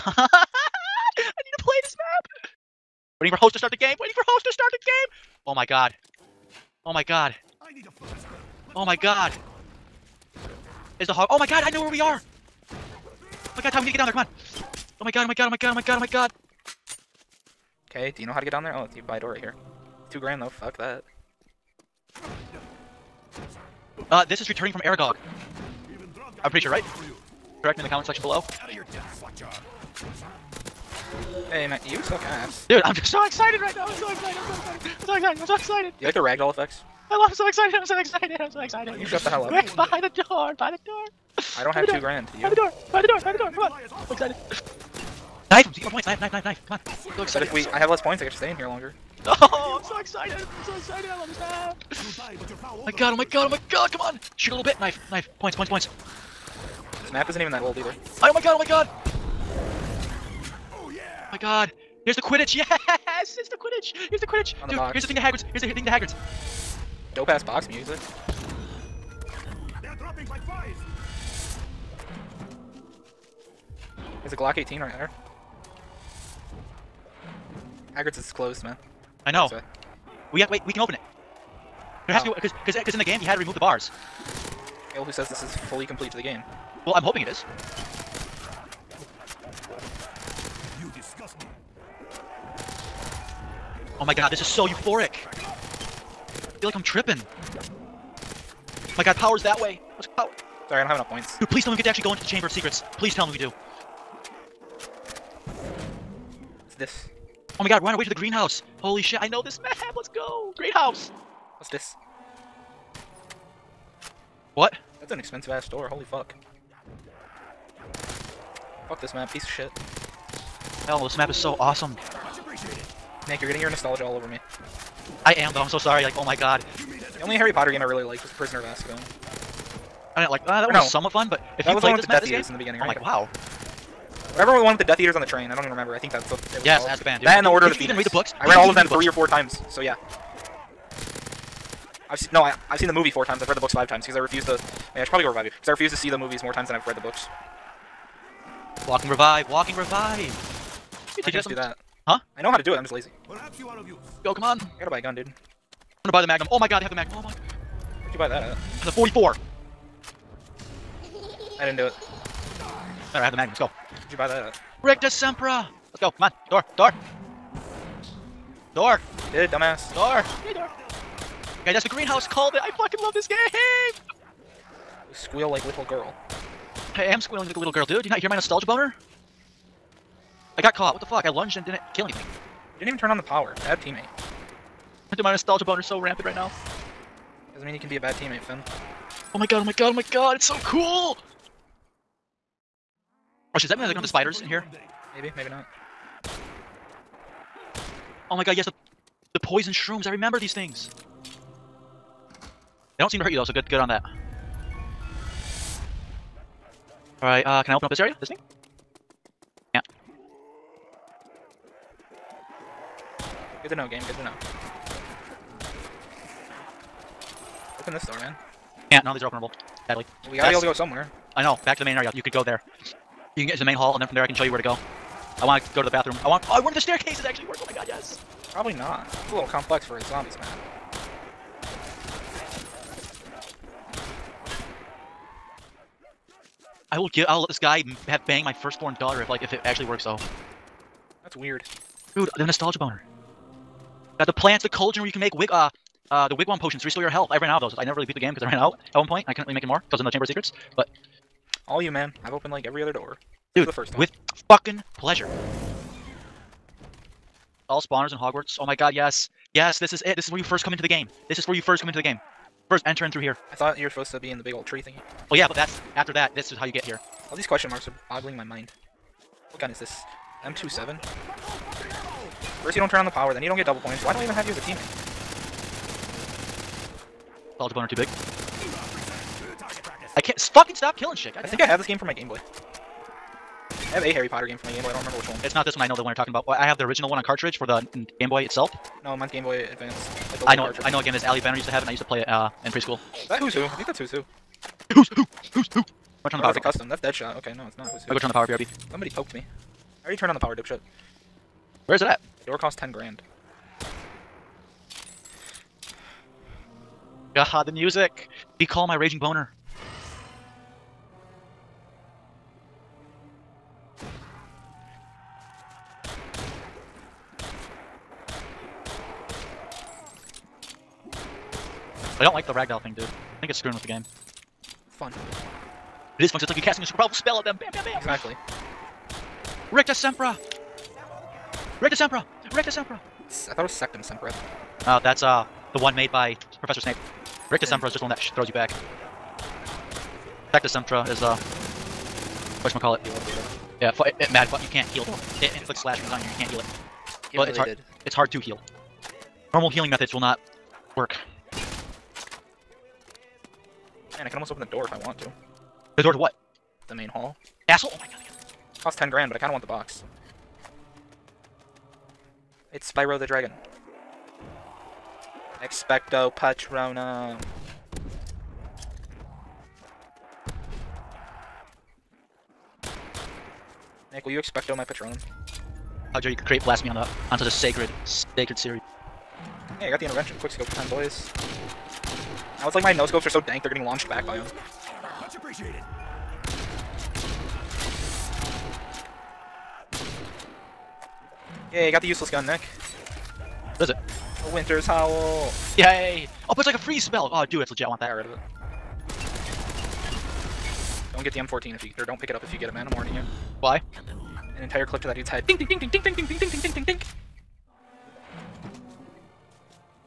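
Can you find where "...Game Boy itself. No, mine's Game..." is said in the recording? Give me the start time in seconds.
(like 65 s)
288 s.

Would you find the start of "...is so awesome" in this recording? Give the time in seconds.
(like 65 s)
121 s.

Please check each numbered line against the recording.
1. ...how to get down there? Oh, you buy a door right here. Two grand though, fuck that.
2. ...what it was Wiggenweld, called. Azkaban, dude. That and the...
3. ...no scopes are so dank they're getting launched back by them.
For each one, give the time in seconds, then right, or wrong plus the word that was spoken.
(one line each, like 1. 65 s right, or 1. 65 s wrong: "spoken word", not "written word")
1. 18 s right
2. 136 s wrong: "Yes", not "Wiggenweld"
3. 382 s right.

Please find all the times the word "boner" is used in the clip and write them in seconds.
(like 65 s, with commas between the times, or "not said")
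178 s, 185 s, 242 s, 277 s, 309 s.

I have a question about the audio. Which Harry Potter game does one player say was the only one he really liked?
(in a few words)
The Prisoner of Azkaban.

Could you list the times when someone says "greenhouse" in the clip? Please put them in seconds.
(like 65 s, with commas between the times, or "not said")
108 s, 171 s.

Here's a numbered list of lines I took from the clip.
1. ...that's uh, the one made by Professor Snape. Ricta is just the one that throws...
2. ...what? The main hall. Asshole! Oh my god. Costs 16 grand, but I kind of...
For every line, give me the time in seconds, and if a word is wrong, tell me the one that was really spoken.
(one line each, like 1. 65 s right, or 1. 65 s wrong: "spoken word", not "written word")
1. 335 s right
2. 356 s wrong: "10", not "16".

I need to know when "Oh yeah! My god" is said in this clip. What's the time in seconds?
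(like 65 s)
60 s.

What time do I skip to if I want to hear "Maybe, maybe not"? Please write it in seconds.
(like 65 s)
195 s.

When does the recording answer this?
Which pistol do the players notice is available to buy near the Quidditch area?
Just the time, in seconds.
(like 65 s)
74 s.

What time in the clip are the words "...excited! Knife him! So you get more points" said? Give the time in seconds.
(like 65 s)
44 s.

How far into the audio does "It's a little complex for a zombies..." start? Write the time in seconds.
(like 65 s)
229 s.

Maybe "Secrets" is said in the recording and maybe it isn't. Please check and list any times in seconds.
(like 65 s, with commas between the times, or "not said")
102 s, 250 s.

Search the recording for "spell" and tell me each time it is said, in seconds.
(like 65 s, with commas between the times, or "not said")
327 s, 397 s.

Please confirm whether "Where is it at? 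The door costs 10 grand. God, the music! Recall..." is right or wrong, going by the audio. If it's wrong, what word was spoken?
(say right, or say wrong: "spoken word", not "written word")
right.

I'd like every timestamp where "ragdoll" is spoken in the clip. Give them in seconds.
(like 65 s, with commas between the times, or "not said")
36 s, 322 s.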